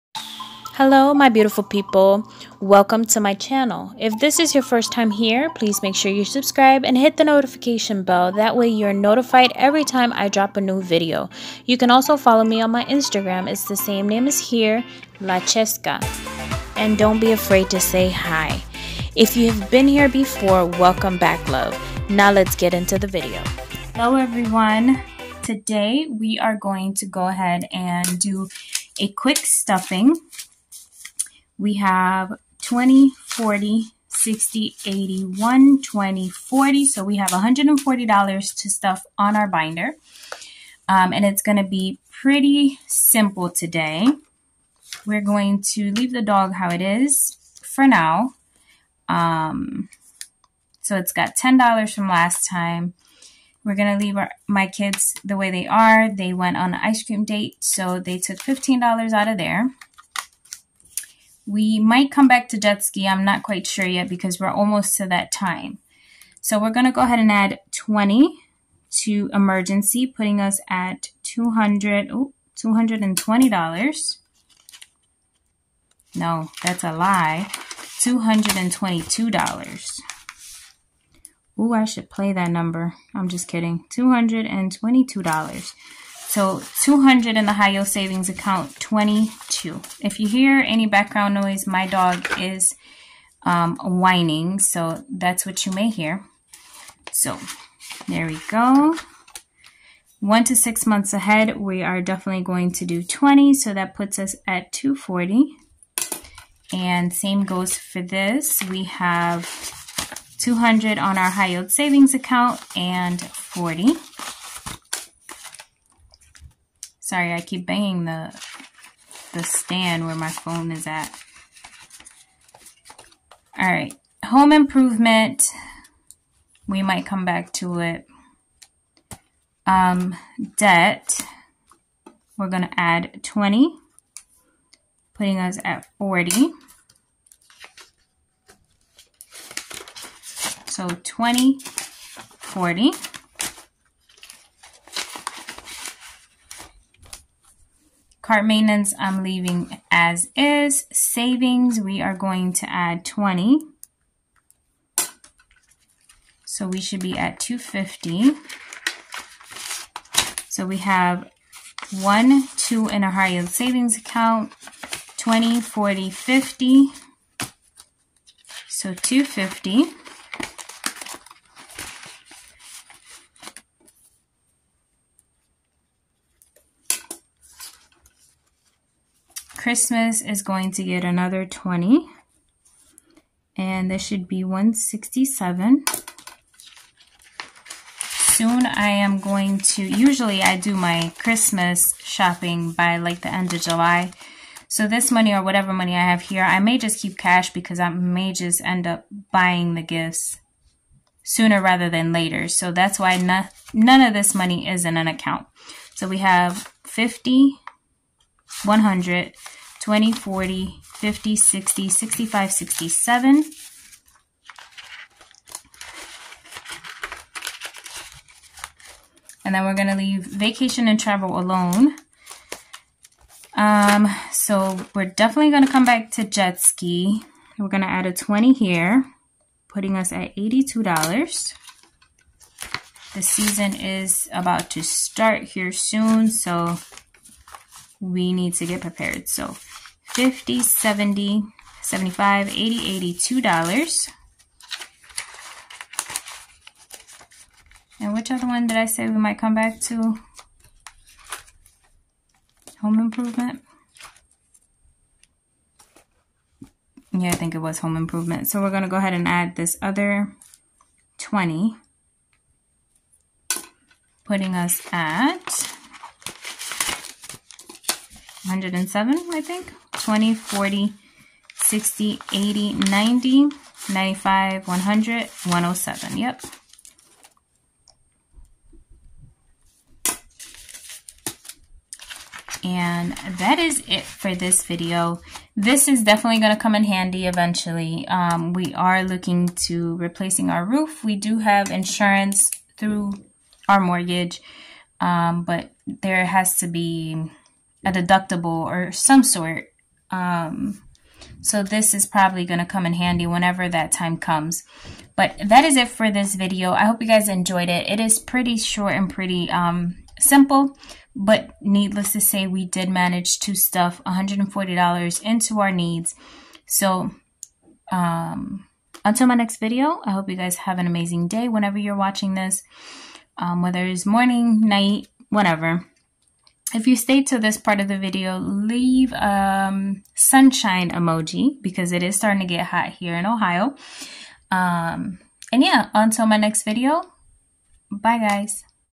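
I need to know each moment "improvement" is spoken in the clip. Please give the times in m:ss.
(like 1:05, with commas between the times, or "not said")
2:04, 4:12, 4:17.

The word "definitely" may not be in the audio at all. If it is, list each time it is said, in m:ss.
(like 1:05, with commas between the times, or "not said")
1:42, 3:45, 4:46.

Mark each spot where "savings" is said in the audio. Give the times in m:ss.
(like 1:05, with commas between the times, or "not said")
1:27, 1:51, 2:30, 2:43.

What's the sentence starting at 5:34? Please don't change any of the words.
Um, and yeah, until my next video, bye guys.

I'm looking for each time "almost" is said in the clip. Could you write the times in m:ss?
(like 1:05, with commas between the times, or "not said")
1:04.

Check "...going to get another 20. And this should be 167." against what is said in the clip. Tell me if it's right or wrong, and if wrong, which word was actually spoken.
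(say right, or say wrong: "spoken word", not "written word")
right.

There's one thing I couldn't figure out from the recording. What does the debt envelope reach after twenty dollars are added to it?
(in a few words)
40.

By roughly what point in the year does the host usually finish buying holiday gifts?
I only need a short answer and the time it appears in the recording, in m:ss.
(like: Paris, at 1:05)
end of July, at 3:13.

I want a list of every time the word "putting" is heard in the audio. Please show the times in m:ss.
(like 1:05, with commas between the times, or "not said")
1:10, 2:15, 3:49, 4:24.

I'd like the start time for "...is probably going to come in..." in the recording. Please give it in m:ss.
5:01.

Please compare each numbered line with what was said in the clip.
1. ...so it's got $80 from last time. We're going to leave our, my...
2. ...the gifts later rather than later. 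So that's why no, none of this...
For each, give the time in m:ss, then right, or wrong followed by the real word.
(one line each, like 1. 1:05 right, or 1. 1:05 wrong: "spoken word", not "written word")
1. 0:50 wrong: "10", not "80"
2. 3:19 wrong: "sooner", not "later".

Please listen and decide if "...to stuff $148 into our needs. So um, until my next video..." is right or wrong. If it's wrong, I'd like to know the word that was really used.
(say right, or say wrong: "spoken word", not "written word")
wrong: "140", not "148".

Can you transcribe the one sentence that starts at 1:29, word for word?
If you hear any background noise, my dog is um, whining, so that's what you may hear.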